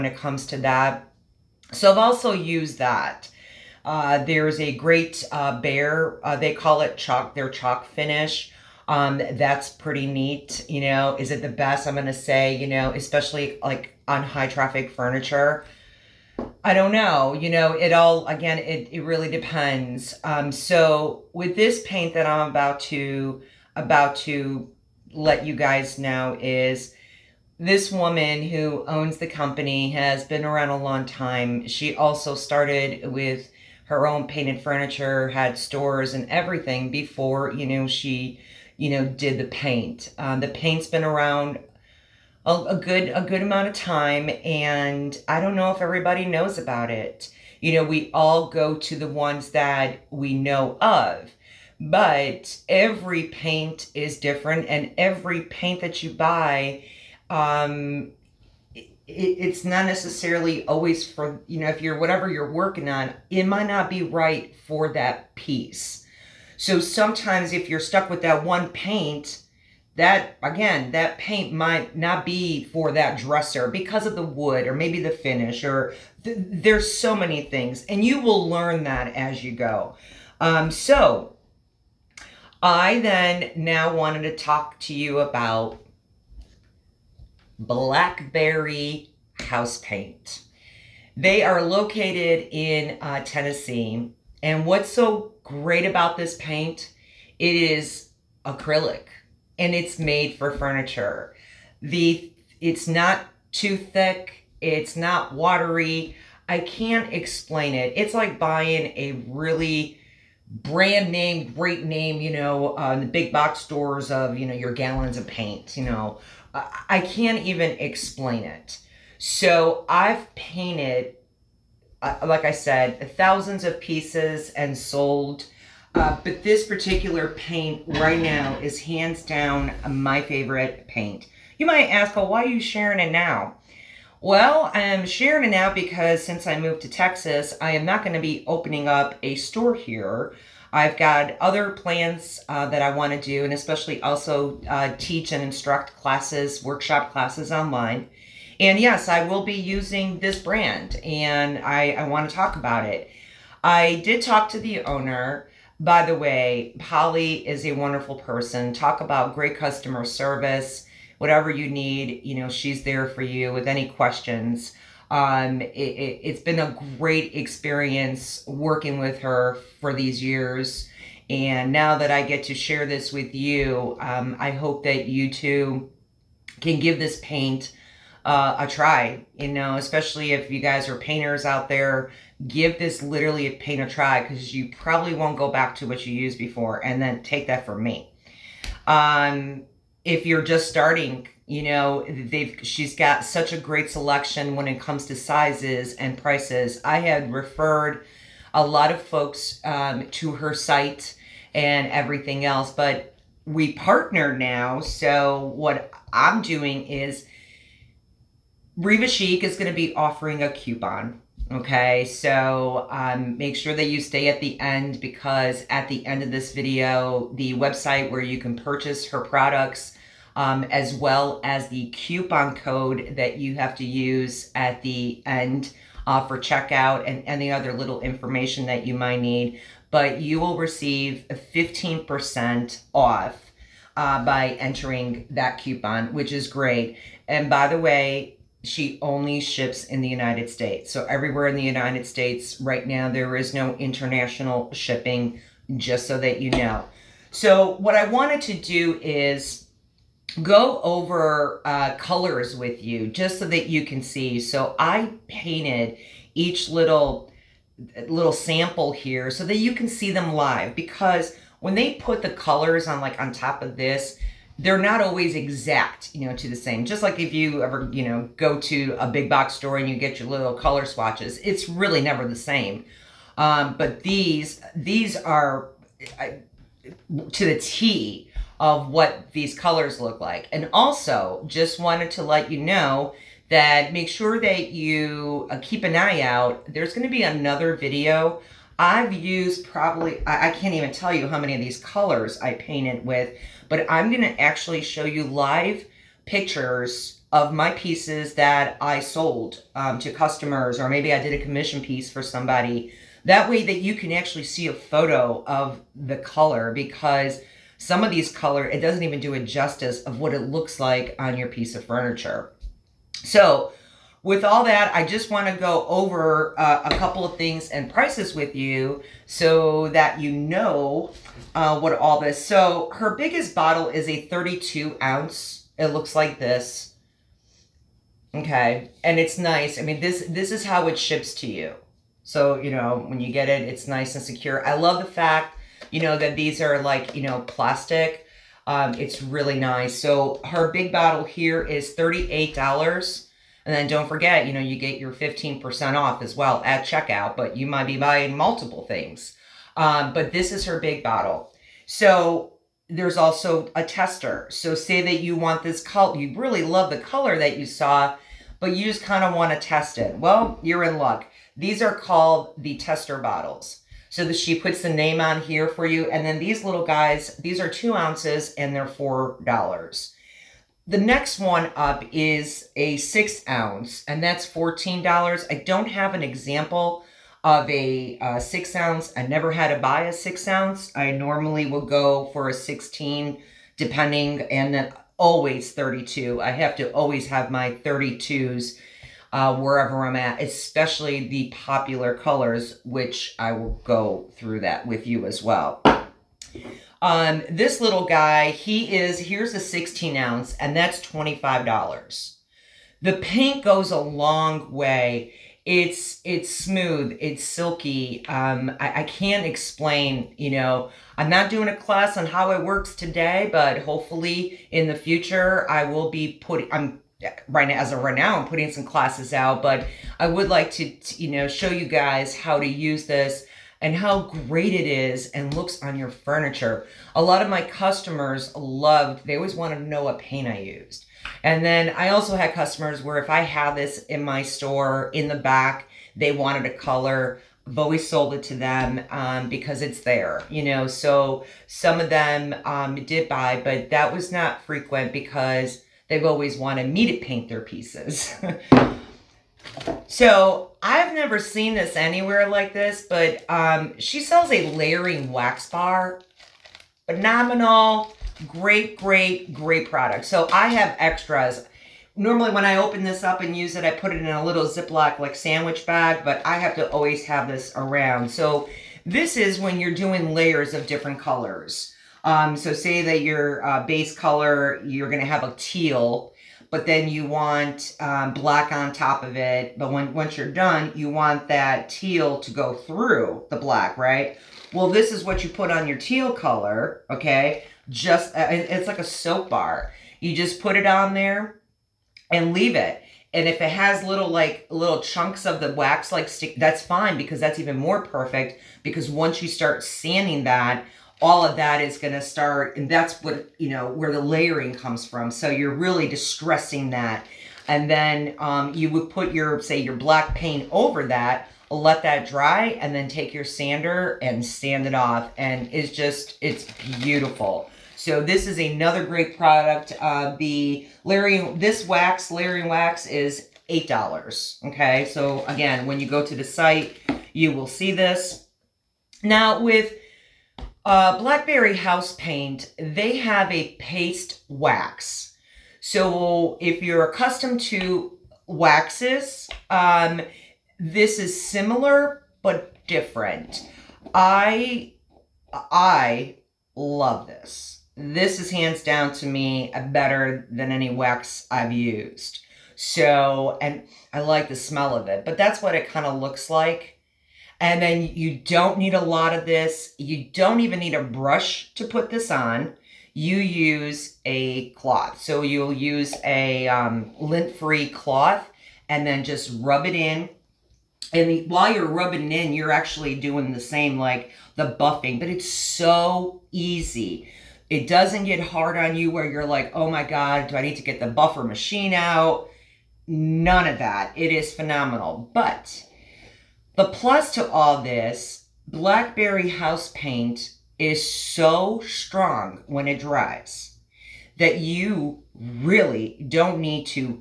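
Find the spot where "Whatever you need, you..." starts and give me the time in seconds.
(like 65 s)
161 s.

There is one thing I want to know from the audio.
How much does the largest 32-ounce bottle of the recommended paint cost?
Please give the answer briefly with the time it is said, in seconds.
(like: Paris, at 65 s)
$38, at 341 s.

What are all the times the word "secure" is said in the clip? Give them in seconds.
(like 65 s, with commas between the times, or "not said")
334 s.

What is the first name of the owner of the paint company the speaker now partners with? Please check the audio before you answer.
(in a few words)
Polly.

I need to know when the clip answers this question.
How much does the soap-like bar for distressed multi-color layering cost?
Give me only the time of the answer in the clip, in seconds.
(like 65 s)
523 s.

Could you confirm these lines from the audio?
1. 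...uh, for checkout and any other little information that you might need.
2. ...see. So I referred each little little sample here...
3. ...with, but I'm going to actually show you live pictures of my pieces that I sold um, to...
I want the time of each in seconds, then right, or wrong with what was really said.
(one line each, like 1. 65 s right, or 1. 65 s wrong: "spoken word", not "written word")
1. 226 s right
2. 254 s wrong: "painted", not "referred"
3. 293 s right.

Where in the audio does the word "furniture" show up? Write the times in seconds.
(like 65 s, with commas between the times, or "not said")
14 s, 34 s, 100 s, 311 s, 426 s.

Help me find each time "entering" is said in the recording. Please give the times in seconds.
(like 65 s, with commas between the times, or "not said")
234 s.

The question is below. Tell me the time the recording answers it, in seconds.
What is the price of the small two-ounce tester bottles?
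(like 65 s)
368 s.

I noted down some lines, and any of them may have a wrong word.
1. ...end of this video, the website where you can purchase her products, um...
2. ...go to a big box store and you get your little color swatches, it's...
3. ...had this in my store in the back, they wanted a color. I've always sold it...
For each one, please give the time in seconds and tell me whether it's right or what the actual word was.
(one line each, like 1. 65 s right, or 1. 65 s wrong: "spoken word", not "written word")
1. 216 s right
2. 268 s right
3. 433 s right.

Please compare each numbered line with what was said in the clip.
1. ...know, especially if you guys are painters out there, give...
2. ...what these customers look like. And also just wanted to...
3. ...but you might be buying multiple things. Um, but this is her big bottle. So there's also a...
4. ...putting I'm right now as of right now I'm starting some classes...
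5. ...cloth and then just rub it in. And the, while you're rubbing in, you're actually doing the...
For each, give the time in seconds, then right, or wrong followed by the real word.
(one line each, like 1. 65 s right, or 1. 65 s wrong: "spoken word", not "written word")
1. 179 s right
2. 278 s wrong: "colors", not "customers"
3. 347 s right
4. 416 s wrong: "putting", not "starting"
5. 567 s right.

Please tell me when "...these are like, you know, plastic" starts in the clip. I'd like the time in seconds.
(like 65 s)
336 s.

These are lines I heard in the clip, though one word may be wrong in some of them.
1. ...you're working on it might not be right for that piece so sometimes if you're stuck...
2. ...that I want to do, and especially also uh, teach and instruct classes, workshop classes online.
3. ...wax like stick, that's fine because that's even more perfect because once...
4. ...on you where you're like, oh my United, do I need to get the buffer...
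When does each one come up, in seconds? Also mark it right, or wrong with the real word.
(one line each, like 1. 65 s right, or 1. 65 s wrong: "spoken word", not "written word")
1. 62 s right
2. 142 s right
3. 495 s right
4. 578 s wrong: "God", not "United".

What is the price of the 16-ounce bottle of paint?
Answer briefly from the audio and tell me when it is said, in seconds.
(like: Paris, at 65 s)
$25, at 400 s.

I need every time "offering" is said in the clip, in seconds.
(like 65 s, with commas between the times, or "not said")
209 s.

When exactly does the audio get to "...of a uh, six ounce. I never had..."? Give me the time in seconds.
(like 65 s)
377 s.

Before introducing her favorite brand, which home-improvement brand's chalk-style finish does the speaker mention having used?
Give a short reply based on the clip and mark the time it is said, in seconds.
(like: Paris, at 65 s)
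Behr, at 5 s.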